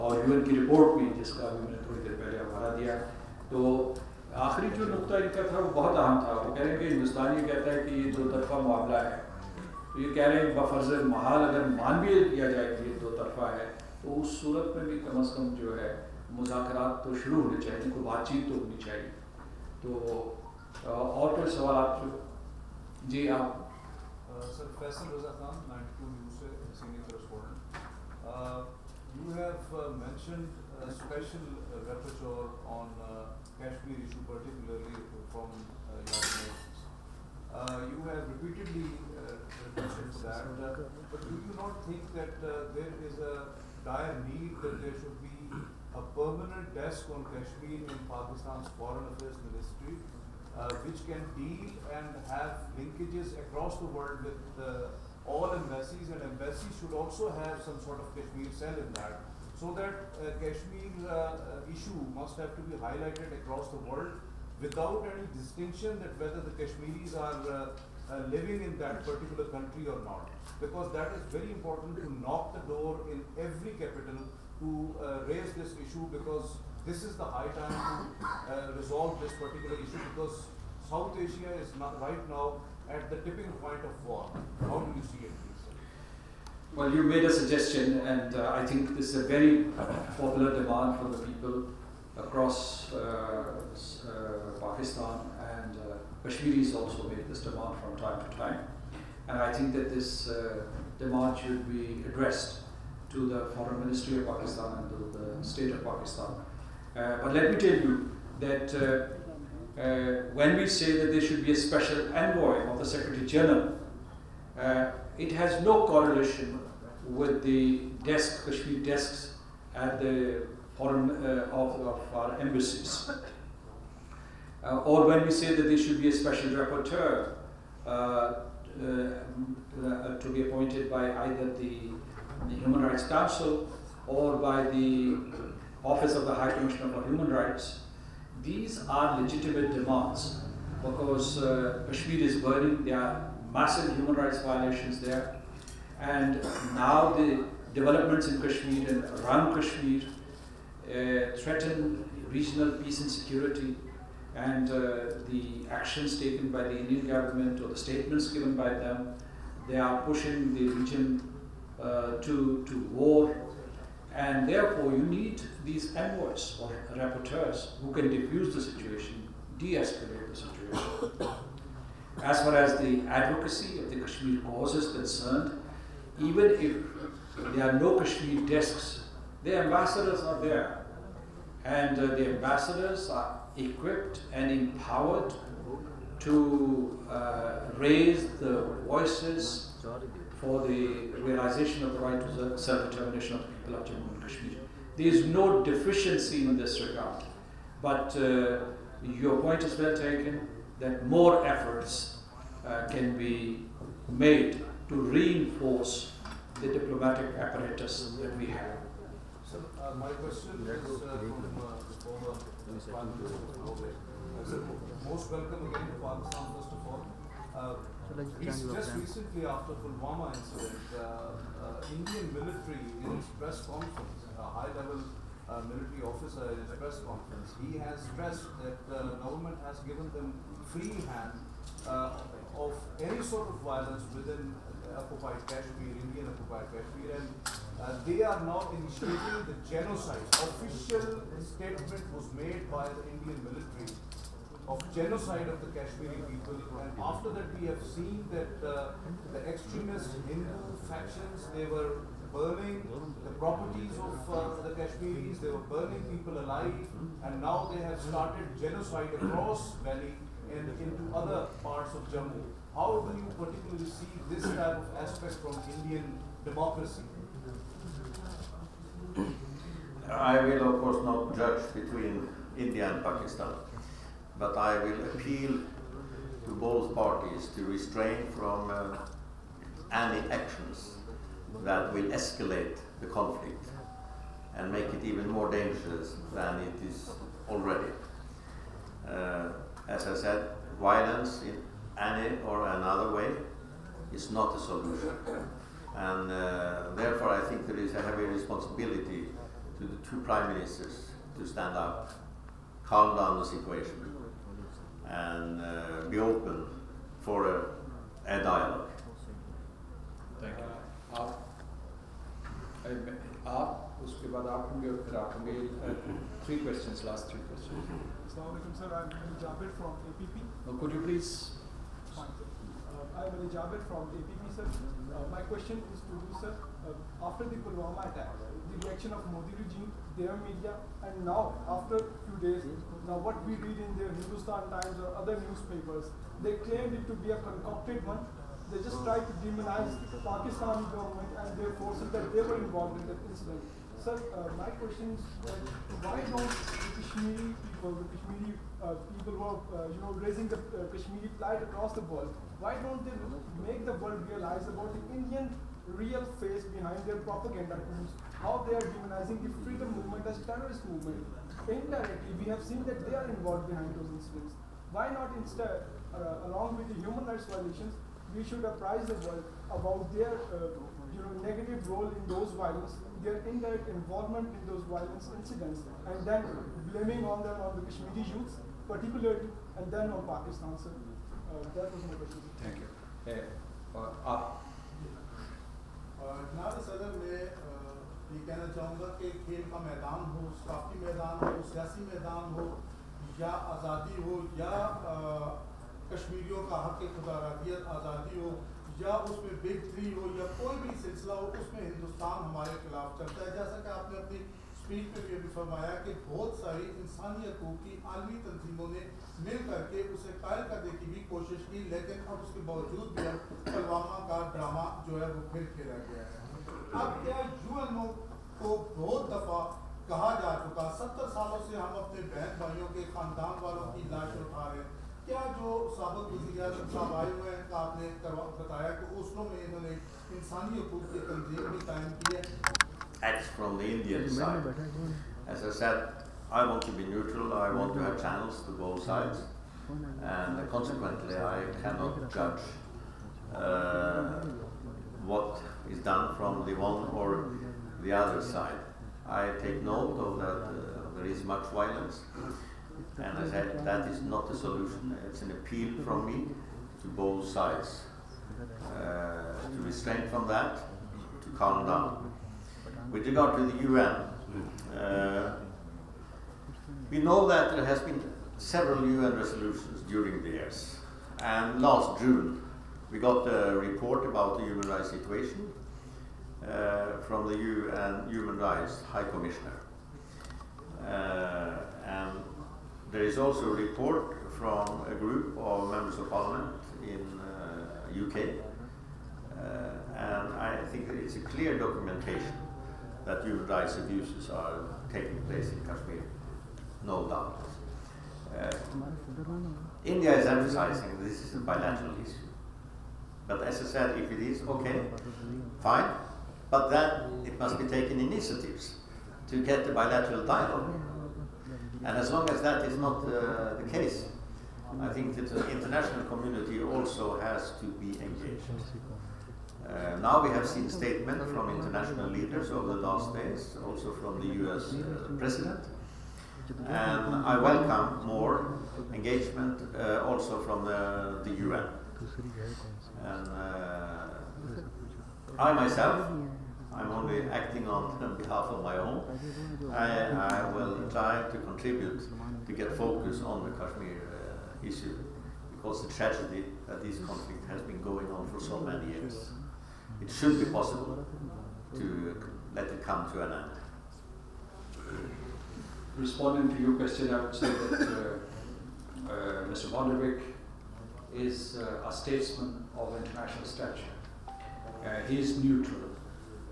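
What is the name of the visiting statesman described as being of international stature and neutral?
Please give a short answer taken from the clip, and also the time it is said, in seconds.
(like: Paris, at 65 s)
Bondevik, at 559 s.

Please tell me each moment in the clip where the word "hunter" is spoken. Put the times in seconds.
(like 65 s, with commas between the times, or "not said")
not said.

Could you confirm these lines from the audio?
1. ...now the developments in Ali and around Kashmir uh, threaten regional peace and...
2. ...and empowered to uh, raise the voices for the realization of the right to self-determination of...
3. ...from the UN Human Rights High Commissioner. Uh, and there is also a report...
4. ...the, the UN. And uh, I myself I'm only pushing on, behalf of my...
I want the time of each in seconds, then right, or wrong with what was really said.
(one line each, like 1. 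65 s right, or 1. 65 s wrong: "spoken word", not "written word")
1. 146 s wrong: "Kashmir", not "Ali"
2. 184 s right
3. 477 s right
4. 530 s wrong: "acting", not "pushing".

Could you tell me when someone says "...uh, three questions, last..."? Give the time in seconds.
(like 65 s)
314 s.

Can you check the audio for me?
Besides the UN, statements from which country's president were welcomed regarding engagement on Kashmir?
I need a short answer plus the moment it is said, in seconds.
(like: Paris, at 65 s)
US, at 524 s.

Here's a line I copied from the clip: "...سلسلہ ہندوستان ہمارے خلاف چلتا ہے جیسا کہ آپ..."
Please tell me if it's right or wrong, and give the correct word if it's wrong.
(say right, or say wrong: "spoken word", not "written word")
right.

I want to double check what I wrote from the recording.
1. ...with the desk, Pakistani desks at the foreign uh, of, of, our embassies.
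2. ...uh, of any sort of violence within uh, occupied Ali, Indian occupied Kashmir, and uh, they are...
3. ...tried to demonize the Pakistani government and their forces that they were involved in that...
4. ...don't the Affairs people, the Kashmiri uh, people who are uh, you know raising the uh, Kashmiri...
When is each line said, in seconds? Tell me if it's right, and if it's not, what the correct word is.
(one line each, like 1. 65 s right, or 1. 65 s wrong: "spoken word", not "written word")
1. 117 s wrong: "Kashmir", not "Pakistani"
2. 231 s wrong: "Kashmir", not "Ali"
3. 339 s right
4. 346 s wrong: "Kashmiri", not "Affairs".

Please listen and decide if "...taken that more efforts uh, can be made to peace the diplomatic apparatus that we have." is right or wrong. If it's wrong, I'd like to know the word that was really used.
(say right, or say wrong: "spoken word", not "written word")
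wrong: "reinforce", not "peace".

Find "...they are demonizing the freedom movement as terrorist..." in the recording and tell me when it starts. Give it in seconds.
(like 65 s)
358 s.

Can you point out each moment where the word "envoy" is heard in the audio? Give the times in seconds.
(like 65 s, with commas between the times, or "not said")
112 s, 165 s.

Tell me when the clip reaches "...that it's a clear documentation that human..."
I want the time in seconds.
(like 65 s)
491 s.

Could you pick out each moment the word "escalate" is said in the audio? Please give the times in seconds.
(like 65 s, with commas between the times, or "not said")
169 s, 282 s.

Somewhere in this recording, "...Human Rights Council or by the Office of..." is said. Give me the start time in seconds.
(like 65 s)
132 s.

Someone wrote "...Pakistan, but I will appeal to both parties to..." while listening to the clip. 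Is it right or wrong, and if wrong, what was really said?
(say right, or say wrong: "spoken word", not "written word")
right.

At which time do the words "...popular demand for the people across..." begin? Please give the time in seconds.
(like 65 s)
90 s.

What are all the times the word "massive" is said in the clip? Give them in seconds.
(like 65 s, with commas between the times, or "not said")
143 s.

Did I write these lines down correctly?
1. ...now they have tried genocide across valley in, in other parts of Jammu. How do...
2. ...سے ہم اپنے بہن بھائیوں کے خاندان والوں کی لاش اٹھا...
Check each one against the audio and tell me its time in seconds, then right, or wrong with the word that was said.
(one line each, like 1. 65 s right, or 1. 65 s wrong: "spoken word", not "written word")
1. 257 s wrong: "started", not "tried"
2. 421 s right.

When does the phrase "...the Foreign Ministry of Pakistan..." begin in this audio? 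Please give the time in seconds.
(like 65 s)
103 s.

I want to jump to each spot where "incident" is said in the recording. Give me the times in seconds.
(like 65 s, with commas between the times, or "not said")
220 s, 343 s, 364 s, 375 s.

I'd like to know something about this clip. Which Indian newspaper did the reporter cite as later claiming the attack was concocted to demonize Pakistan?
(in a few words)
Hindustan Times.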